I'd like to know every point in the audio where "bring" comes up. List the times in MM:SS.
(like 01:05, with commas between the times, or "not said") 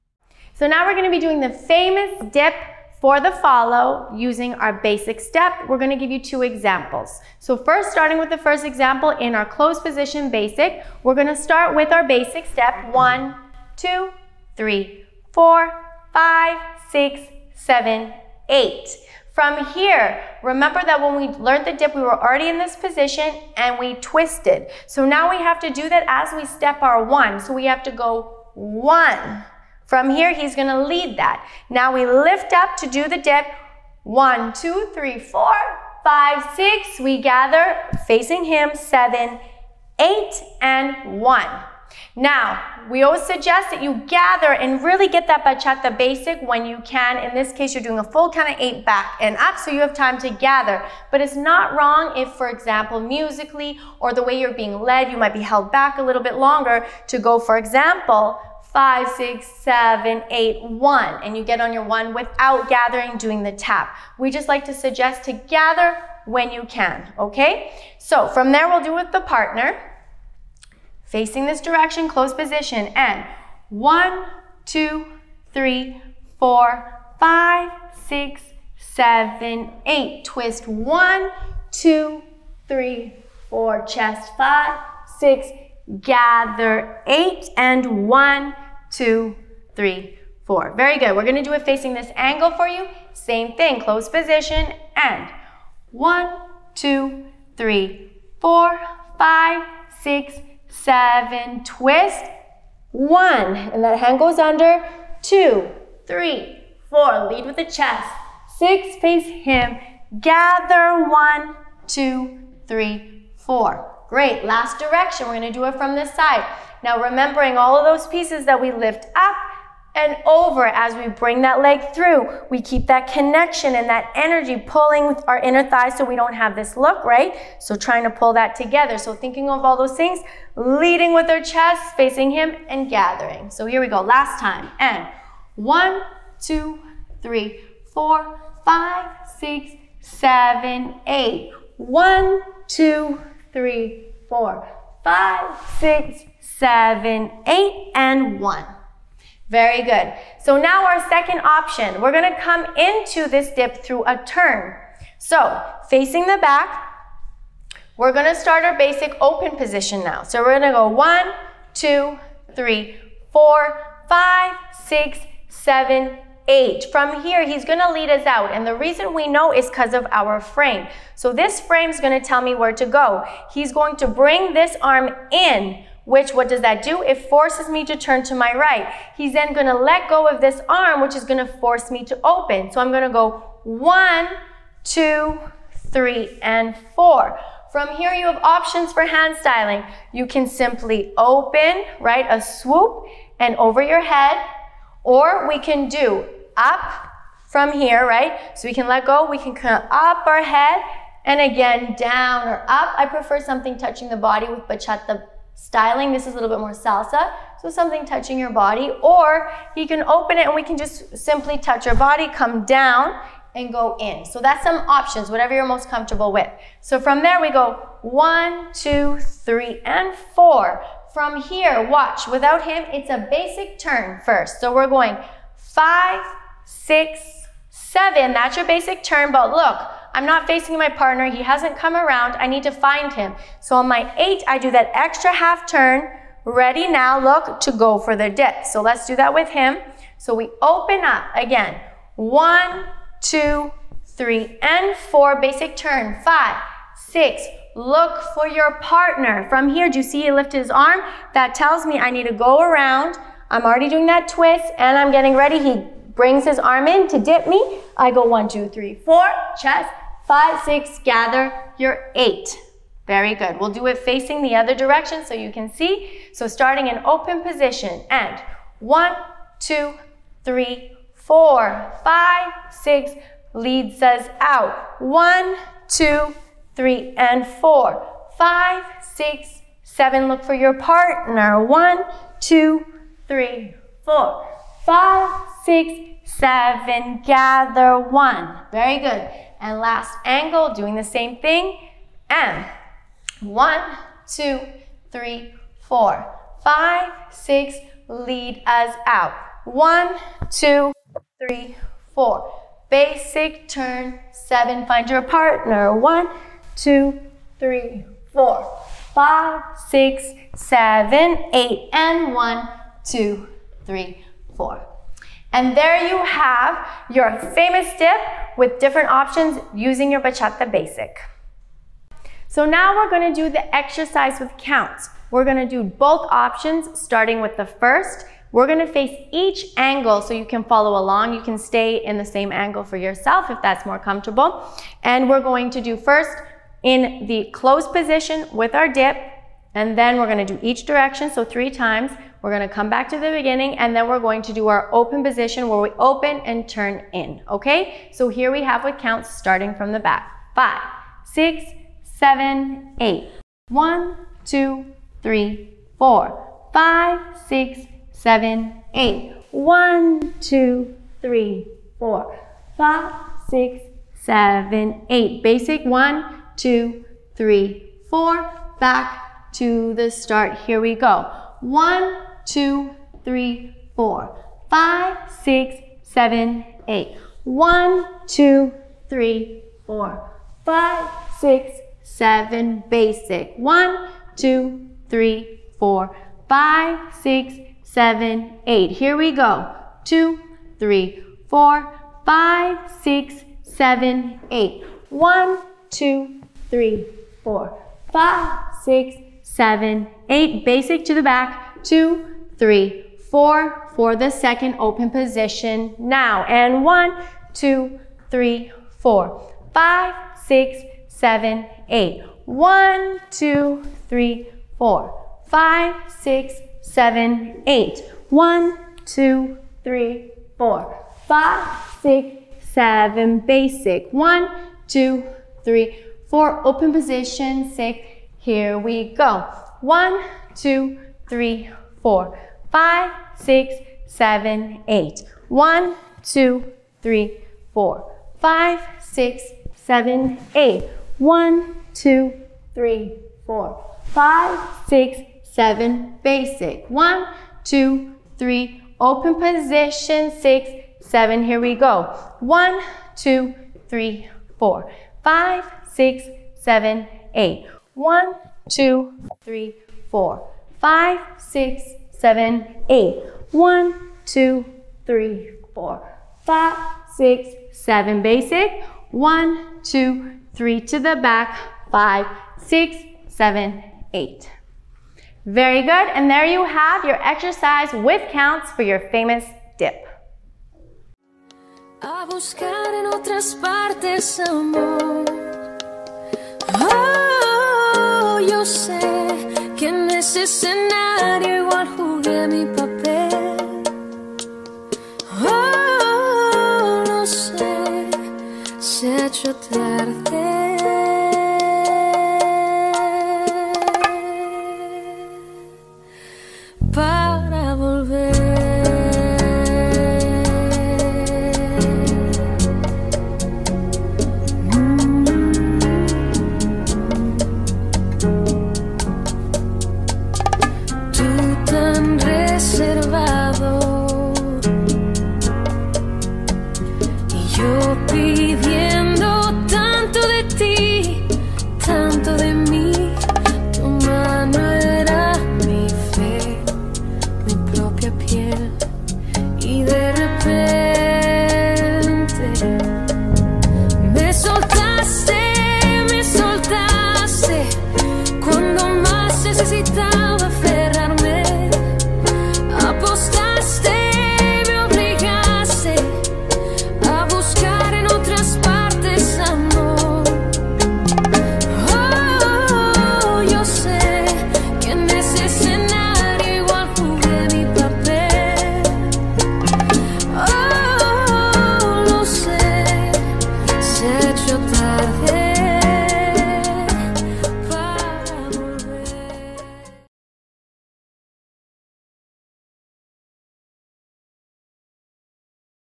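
02:01, 02:54, 04:16.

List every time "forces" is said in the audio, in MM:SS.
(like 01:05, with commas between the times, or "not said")
02:57, 03:01.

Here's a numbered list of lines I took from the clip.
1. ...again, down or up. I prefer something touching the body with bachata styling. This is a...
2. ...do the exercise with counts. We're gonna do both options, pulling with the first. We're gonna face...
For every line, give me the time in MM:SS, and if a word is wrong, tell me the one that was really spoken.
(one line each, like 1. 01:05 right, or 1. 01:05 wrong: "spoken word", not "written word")
1. 03:21 right
2. 05:23 wrong: "starting", not "pulling".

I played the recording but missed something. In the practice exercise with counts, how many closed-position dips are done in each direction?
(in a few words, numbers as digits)
3.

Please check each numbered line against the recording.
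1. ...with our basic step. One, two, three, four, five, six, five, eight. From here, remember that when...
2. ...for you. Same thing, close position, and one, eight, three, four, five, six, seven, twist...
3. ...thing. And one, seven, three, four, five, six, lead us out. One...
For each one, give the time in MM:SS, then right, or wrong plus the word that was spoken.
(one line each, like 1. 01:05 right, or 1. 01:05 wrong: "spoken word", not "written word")
1. 00:11 wrong: "seven", not "five"
2. 01:32 wrong: "two", not "eight"
3. 04:51 wrong: "two", not "seven".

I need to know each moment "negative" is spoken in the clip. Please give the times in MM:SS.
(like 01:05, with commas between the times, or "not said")
not said.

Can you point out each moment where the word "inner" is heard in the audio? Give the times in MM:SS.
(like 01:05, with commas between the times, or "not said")
02:05.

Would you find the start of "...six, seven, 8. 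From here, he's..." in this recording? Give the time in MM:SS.
02:44.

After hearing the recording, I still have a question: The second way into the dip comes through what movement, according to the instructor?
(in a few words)
A turn.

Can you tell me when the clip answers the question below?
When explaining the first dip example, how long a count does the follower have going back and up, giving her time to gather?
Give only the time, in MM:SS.
00:48.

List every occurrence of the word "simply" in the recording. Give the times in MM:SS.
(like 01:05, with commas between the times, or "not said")
03:10, 03:31.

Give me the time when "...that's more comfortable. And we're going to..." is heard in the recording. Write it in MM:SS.
05:33.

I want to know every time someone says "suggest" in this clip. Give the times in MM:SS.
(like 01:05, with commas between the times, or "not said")
00:43, 01:04.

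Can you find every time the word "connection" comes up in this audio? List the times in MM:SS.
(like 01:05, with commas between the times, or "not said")
02:03.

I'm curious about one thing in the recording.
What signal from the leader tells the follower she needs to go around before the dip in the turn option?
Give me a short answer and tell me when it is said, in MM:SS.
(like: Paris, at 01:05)
He lifted his arm, at 04:10.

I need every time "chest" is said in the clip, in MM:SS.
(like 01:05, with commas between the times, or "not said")
01:23, 01:47, 02:11, 04:19.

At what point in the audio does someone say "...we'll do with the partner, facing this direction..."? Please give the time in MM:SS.
01:08.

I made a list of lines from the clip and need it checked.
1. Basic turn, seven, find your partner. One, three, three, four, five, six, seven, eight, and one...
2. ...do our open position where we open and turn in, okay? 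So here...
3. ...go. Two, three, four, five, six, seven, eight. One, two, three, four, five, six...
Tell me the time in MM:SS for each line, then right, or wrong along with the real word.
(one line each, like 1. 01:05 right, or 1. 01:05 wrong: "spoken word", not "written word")
1. 05:02 wrong: "two", not "three"
2. 05:44 right
3. 06:29 right.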